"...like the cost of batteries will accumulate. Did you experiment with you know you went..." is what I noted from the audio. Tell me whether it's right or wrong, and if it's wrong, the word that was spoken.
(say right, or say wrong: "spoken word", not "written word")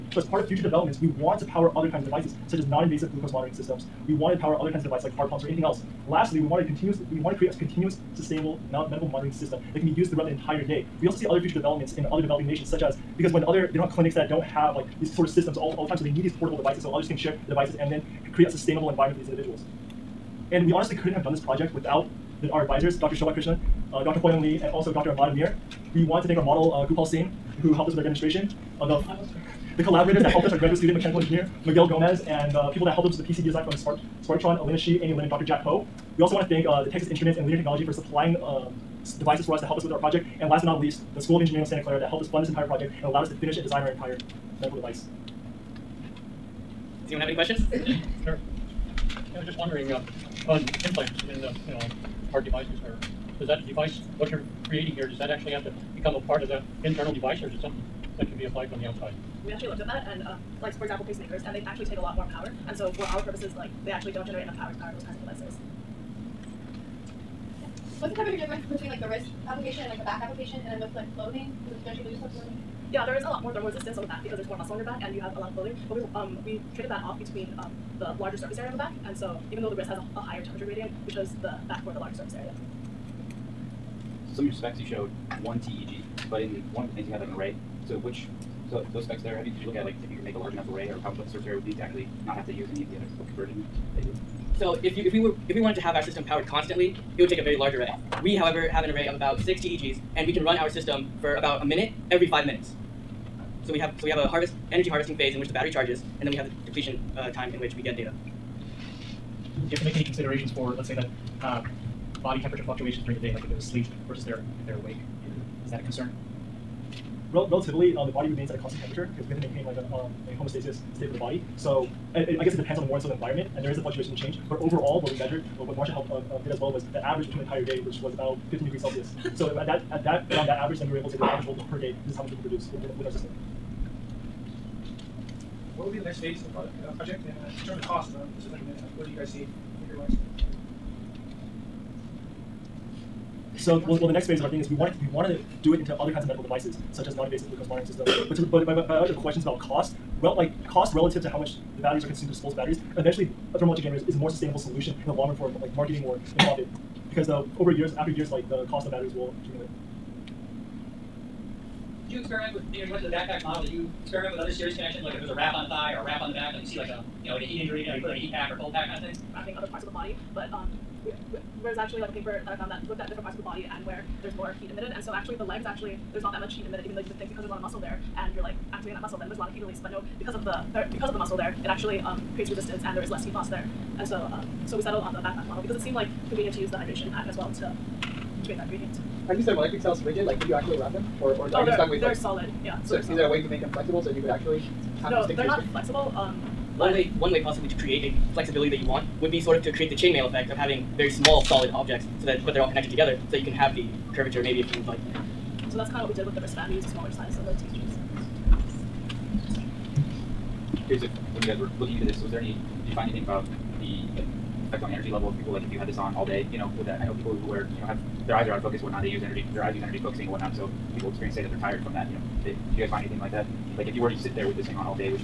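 right.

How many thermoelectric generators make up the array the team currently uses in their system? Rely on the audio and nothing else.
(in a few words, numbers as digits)
6.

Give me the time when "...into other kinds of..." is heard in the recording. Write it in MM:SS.
02:25.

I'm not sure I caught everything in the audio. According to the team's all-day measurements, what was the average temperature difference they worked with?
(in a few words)
15 degrees Celsius.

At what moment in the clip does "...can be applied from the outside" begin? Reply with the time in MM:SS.
00:58.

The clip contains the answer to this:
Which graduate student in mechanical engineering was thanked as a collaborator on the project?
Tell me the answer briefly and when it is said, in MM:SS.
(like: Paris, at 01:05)
Miguel Gomez, at 00:31.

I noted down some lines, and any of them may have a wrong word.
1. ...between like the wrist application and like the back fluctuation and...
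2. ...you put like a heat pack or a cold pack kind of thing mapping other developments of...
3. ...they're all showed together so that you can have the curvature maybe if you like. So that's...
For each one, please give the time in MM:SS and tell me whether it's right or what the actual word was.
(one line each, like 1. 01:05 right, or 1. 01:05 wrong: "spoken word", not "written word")
1. 01:08 wrong: "application", not "fluctuation"
2. 02:47 wrong: "parts", not "developments"
3. 03:22 wrong: "connected", not "showed".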